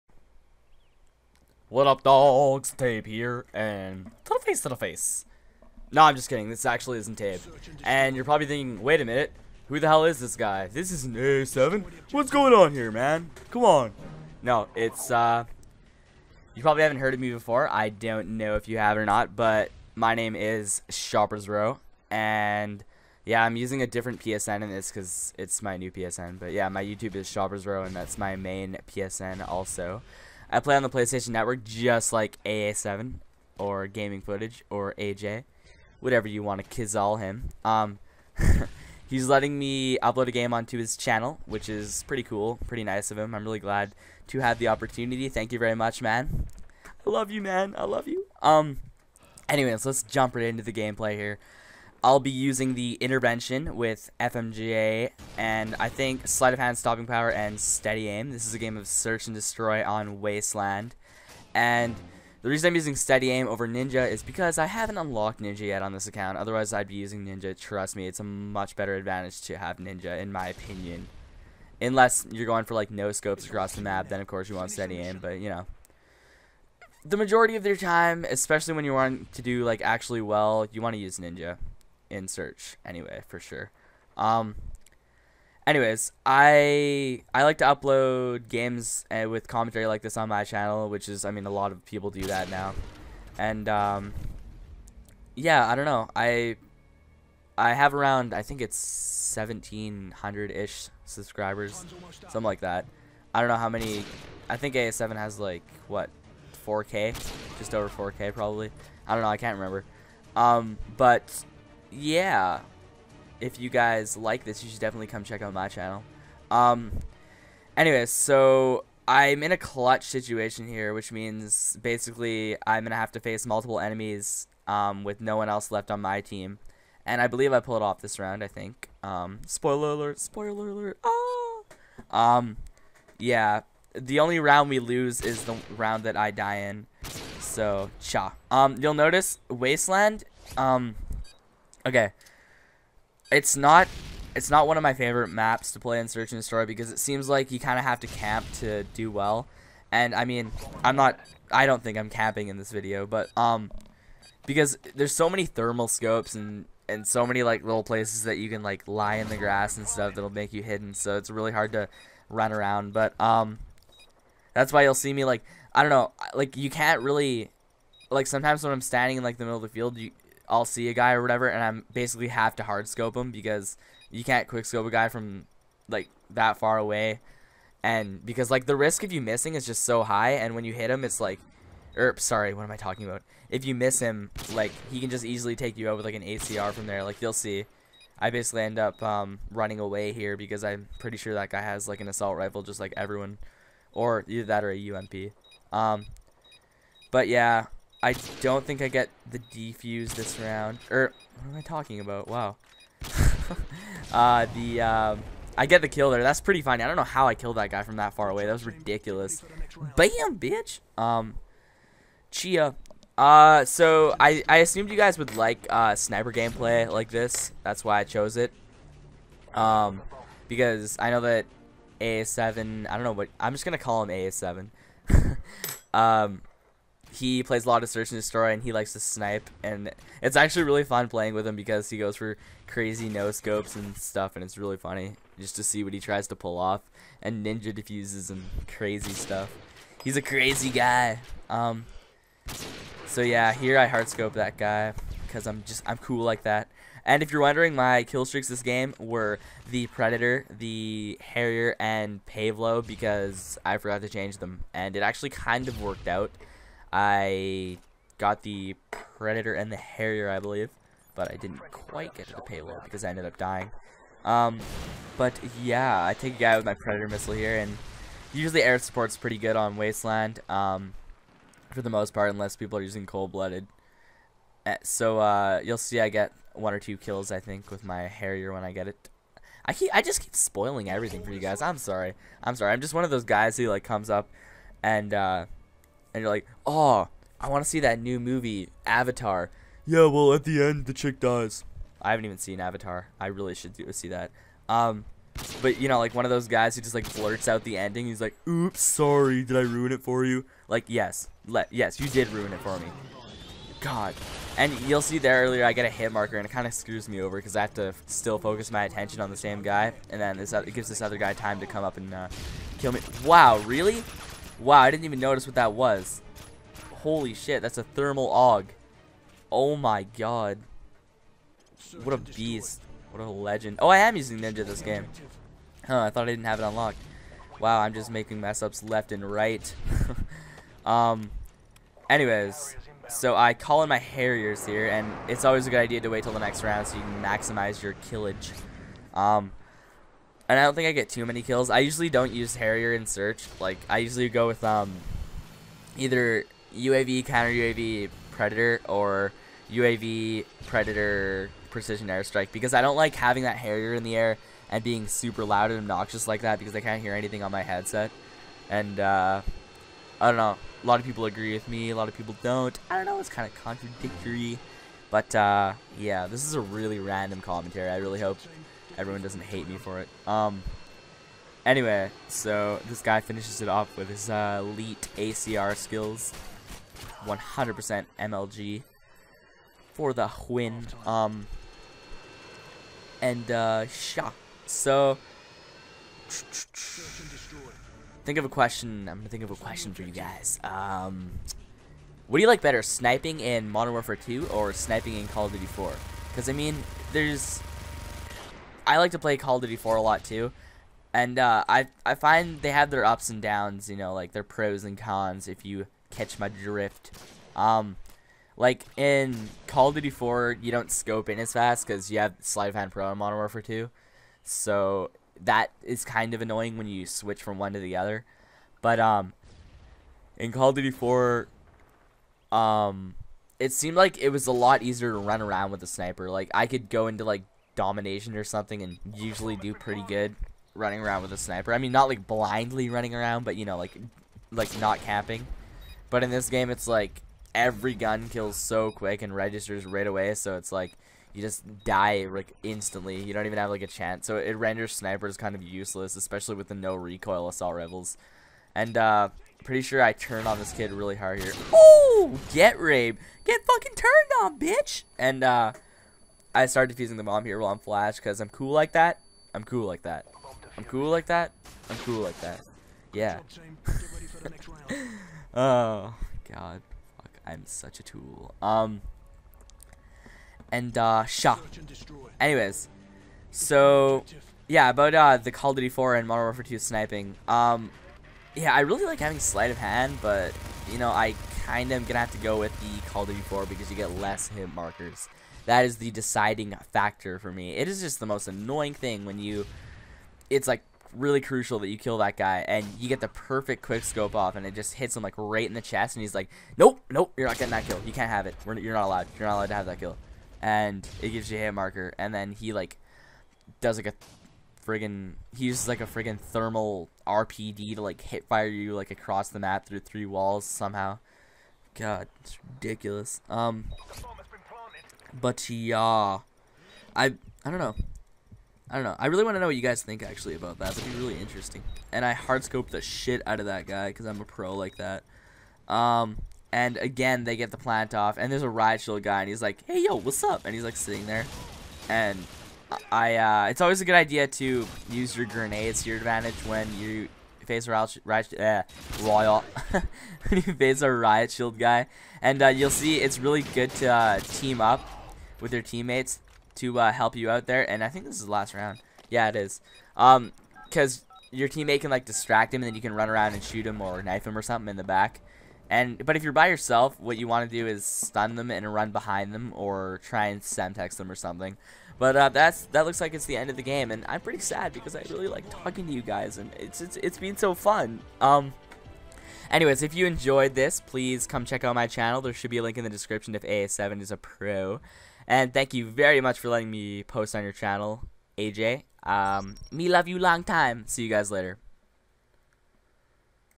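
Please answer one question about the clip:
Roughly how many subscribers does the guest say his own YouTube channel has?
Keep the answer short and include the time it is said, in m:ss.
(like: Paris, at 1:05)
1700, at 1:39.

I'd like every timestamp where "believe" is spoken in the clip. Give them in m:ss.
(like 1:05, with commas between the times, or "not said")
2:07, 4:20.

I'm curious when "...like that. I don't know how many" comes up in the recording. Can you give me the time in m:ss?
1:42.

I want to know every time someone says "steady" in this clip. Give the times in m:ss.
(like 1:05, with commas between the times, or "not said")
0:57, 1:02, 1:14.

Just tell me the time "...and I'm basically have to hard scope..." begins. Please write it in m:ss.
2:51.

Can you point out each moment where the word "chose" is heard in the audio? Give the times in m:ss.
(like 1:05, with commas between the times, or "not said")
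3:38.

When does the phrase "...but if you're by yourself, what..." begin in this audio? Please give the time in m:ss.
9:16.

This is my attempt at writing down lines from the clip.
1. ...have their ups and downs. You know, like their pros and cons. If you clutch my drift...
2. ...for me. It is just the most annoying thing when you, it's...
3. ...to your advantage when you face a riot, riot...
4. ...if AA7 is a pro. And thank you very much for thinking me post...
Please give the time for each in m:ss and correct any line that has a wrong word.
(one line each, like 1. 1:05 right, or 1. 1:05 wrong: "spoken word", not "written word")
1. 6:42 wrong: "catch", not "clutch"
2. 8:07 right
3. 8:56 right
4. 9:33 wrong: "letting", not "thinking".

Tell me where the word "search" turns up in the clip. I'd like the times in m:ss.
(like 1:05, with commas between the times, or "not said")
0:58, 1:22, 2:26, 3:47, 5:43.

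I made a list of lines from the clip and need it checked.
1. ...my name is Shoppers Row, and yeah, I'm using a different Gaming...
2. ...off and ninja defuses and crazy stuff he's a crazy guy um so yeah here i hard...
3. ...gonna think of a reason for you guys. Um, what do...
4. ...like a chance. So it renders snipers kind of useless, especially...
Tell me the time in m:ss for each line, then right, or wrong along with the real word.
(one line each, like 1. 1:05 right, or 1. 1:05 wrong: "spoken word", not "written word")
1. 0:19 wrong: "PSN", not "Gaming"
2. 3:56 right
3. 6:29 wrong: "question", not "reason"
4. 7:23 right.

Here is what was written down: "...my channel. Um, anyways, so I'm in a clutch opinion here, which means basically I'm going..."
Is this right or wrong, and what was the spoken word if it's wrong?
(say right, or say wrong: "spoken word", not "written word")
wrong: "situation", not "opinion".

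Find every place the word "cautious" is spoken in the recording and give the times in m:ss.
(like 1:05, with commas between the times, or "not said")
not said.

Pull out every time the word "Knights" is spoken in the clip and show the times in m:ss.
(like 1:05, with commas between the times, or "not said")
not said.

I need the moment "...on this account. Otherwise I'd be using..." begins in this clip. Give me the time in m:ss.
1:05.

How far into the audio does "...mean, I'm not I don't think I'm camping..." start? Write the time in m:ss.
2:30.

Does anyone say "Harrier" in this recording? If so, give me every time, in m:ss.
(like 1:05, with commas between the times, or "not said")
4:11, 4:19, 4:38, 5:33, 5:42, 5:53.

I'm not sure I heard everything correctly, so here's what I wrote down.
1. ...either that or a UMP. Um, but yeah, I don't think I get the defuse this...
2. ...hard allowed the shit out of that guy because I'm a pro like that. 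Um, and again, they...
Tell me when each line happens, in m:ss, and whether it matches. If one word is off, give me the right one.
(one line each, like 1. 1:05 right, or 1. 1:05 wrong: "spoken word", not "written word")
1. 3:14 right
2. 8:42 wrong: "scoped", not "allowed".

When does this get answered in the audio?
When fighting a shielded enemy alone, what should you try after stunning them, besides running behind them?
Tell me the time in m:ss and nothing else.
9:20.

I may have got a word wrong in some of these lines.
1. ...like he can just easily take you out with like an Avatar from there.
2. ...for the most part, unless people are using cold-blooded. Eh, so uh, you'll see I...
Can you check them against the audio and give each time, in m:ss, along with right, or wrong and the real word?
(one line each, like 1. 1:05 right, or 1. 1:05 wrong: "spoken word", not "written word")
1. 3:04 wrong: "ACR", not "Avatar"
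2. 4:31 right.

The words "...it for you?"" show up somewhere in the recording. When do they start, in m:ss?
4:59.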